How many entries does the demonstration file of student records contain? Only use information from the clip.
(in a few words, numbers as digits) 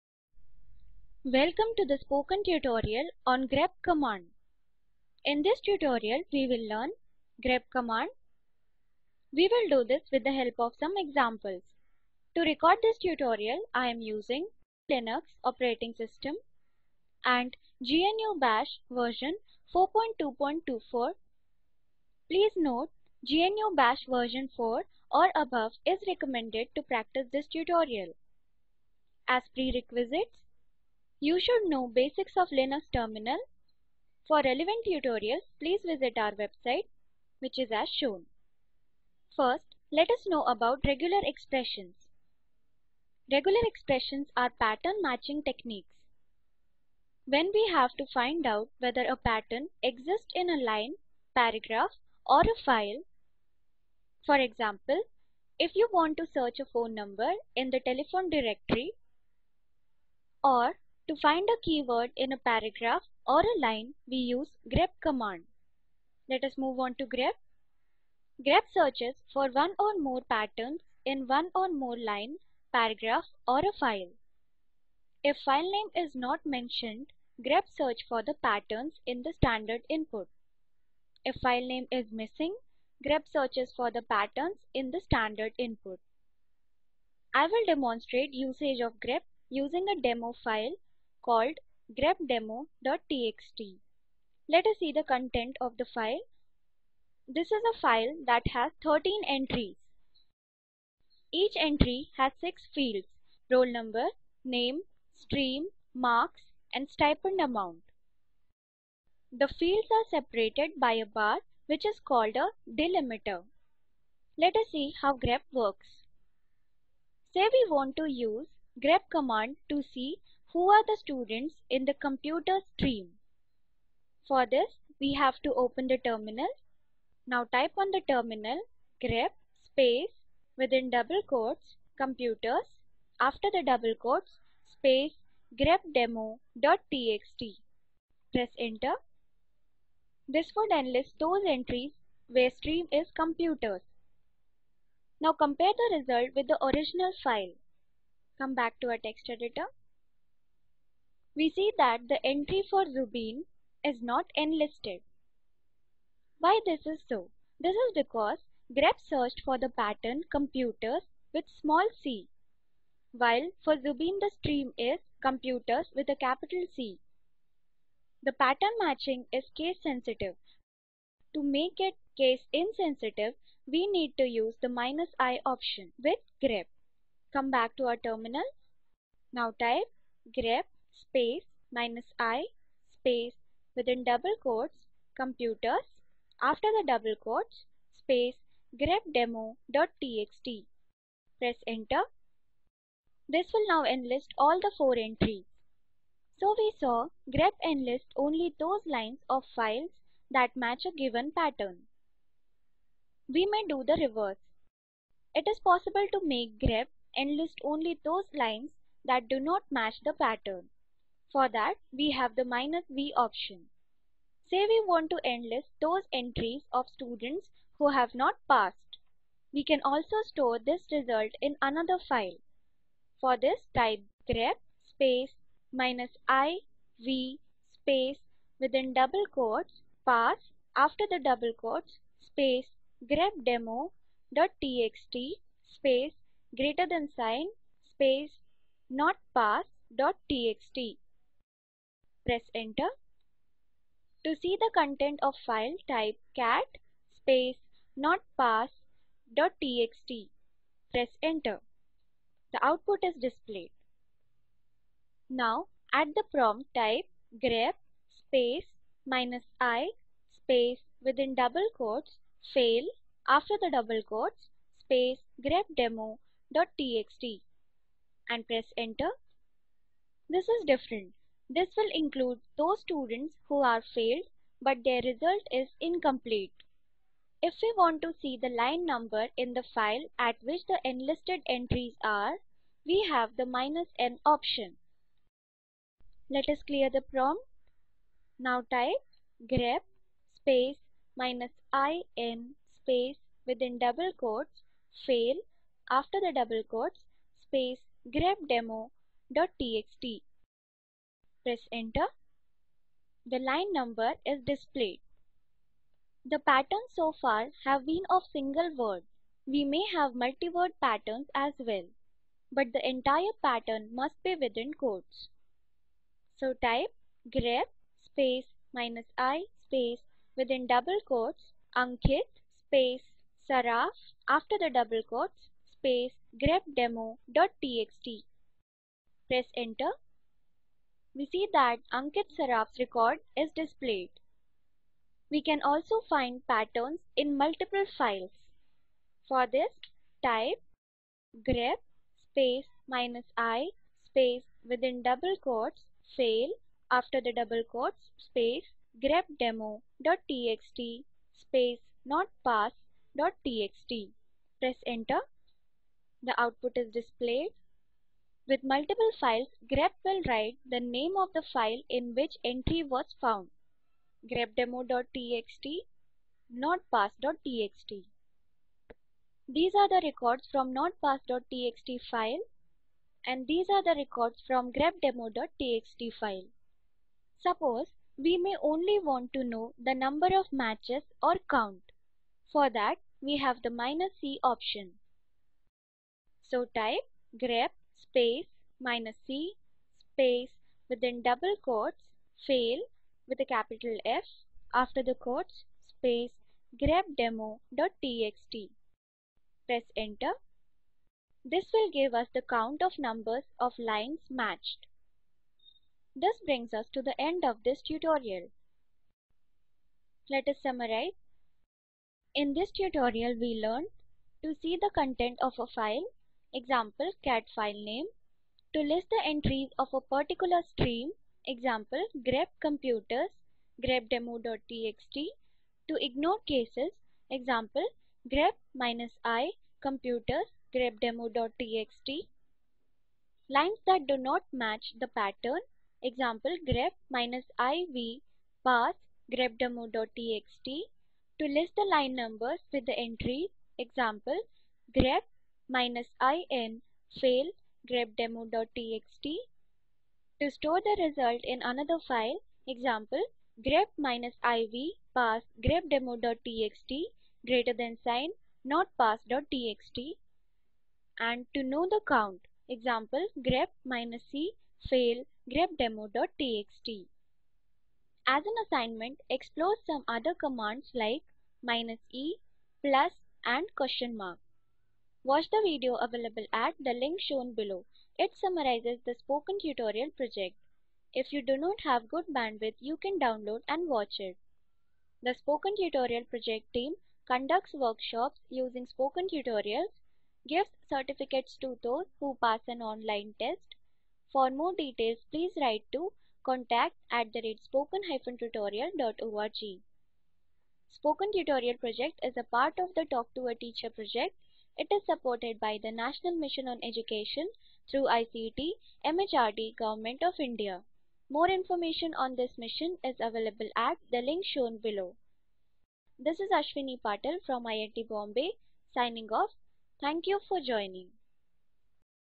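13.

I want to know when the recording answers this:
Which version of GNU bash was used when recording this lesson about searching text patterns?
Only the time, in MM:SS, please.
00:19.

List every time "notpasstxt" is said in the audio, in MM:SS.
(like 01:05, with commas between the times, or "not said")
04:07, 06:06, 06:10.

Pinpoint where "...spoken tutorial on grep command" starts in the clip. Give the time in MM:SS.
00:01.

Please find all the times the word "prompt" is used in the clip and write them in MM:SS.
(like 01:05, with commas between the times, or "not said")
04:16, 04:47.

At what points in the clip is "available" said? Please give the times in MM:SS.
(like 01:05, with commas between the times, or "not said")
07:55, 08:33.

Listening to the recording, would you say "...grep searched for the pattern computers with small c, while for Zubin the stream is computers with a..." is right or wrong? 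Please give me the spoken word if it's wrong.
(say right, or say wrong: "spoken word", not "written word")
right.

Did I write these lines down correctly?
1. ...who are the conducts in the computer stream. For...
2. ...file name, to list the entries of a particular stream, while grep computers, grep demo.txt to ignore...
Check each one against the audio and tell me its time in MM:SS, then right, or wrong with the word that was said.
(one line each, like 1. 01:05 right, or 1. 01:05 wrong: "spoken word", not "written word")
1. 02:00 wrong: "students", not "conducts"
2. 06:57 wrong: "example", not "while".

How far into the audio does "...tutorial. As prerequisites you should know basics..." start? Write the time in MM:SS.
00:27.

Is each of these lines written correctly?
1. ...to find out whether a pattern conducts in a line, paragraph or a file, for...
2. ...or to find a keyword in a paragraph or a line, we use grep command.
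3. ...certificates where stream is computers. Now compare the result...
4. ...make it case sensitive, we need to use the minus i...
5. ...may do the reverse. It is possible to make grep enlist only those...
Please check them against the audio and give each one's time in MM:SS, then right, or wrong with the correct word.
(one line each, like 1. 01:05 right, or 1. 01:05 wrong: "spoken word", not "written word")
1. 00:47 wrong: "exists", not "conducts"
2. 01:00 right
3. 02:21 wrong: "entries", not "certificates"
4. 02:51 wrong: "insensitive", not "sensitive"
5. 03:23 right.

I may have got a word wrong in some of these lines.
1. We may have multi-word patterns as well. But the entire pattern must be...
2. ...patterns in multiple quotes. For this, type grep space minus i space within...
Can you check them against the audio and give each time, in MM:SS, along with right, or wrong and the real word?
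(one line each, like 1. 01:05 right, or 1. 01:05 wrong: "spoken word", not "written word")
1. 05:09 right
2. 05:36 wrong: "files", not "quotes".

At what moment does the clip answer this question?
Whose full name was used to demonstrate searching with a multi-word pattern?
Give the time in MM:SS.
05:31.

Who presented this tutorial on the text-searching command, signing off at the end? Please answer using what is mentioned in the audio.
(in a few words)
Ashwini Patel.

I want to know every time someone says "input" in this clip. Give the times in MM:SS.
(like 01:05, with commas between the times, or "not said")
01:19, 01:25.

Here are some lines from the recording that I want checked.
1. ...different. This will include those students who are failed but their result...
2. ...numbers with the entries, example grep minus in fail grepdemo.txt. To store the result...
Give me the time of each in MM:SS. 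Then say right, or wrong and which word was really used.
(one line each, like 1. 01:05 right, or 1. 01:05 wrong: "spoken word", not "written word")
1. 04:30 right
2. 07:22 right.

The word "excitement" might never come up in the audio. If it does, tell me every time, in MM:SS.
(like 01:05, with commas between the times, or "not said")
not said.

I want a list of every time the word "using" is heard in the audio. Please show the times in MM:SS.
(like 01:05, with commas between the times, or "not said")
00:14, 01:29, 08:08.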